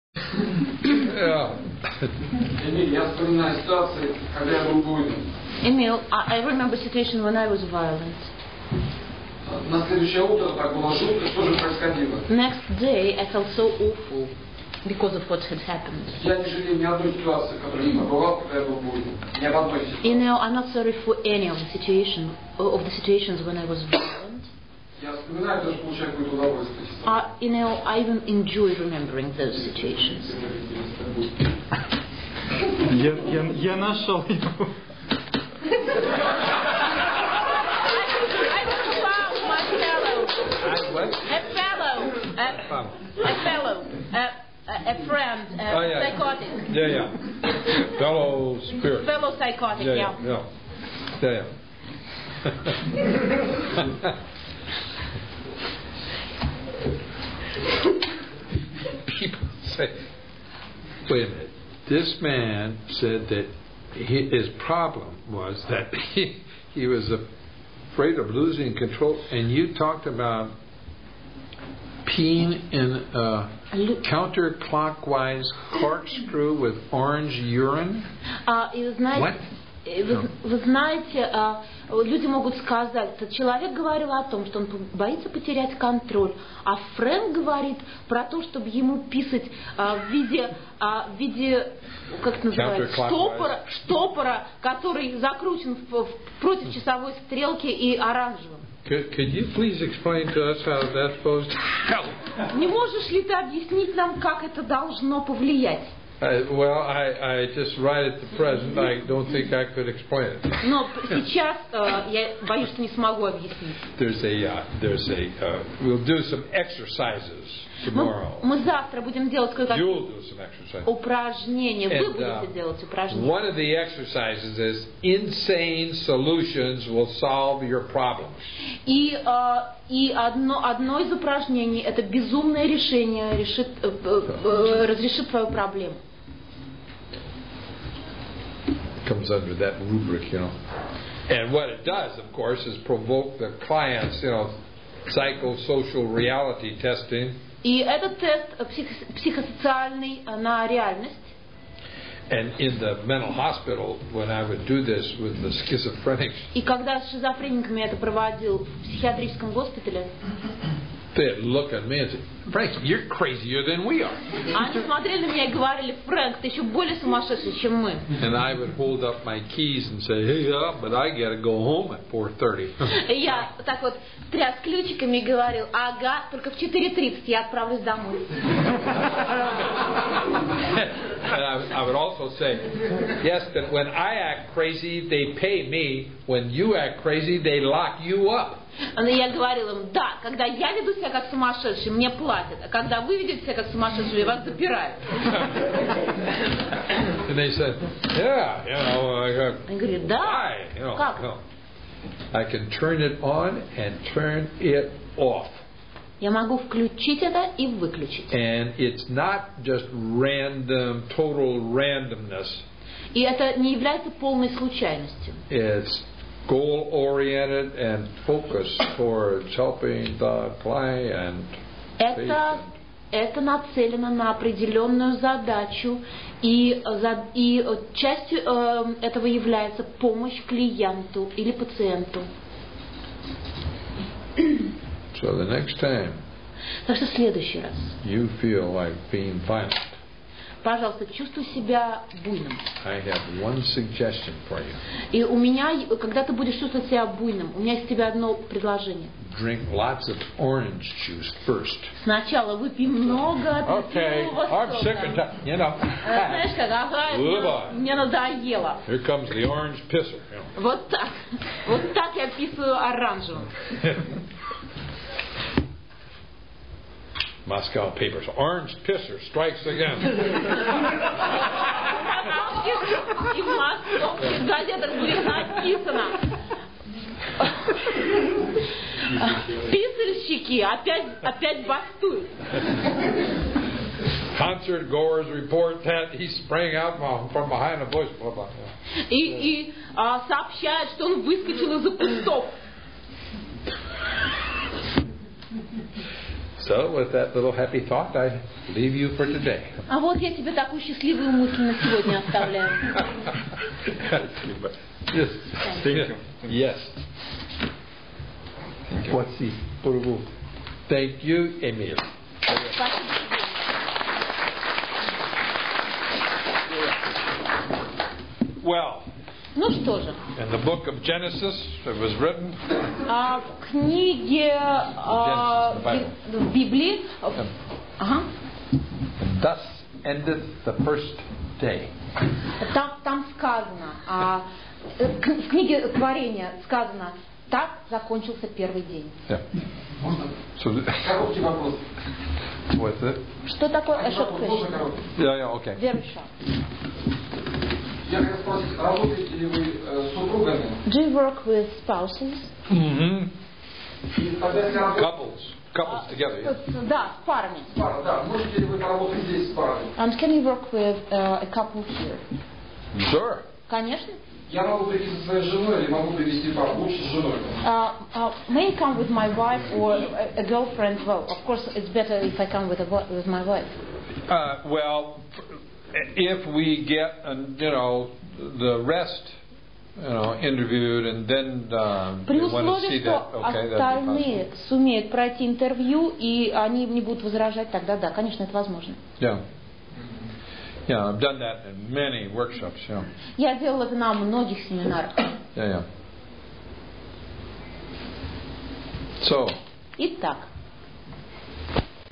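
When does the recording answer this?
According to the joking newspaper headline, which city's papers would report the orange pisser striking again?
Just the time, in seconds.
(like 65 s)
267 s.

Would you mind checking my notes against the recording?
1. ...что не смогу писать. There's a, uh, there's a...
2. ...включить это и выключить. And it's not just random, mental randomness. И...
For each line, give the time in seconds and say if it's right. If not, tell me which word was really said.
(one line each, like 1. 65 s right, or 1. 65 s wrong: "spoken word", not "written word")
1. 112 s wrong: "объяснить", not "писать"
2. 206 s wrong: "total", not "mental".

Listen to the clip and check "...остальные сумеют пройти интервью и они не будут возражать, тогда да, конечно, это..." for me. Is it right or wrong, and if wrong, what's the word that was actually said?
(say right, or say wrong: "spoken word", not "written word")
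right.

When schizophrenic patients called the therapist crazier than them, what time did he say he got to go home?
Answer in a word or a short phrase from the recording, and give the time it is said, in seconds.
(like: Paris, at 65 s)
4:30, at 172 s.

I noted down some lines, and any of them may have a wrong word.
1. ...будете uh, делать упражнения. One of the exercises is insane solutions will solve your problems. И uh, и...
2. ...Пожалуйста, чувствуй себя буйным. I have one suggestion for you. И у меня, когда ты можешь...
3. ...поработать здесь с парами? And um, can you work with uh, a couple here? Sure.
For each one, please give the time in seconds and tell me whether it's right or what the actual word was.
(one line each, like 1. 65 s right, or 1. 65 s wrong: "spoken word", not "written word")
1. 122 s right
2. 240 s wrong: "будешь", not "можешь"
3. 358 s right.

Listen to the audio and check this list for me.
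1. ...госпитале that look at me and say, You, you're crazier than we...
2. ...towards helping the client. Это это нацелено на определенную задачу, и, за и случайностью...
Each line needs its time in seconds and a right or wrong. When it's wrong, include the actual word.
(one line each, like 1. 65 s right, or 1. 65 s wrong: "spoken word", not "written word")
1. 159 s wrong: "Frank", not "You"
2. 218 s wrong: "частью", not "случайностью".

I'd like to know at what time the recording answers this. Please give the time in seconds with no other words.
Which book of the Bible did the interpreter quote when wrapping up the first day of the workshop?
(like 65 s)
321 s.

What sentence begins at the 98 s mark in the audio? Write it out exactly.
could you please explain to us how that's supposed to help?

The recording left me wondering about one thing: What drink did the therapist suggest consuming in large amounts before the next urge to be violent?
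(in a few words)
Orange juice.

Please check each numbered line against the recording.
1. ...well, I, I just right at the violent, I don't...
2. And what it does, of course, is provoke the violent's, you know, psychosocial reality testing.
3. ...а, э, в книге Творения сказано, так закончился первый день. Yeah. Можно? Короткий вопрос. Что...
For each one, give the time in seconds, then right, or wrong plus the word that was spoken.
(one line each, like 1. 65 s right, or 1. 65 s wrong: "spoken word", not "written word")
1. 106 s wrong: "present", not "violent"
2. 141 s wrong: "client", not "violent"
3. 334 s right.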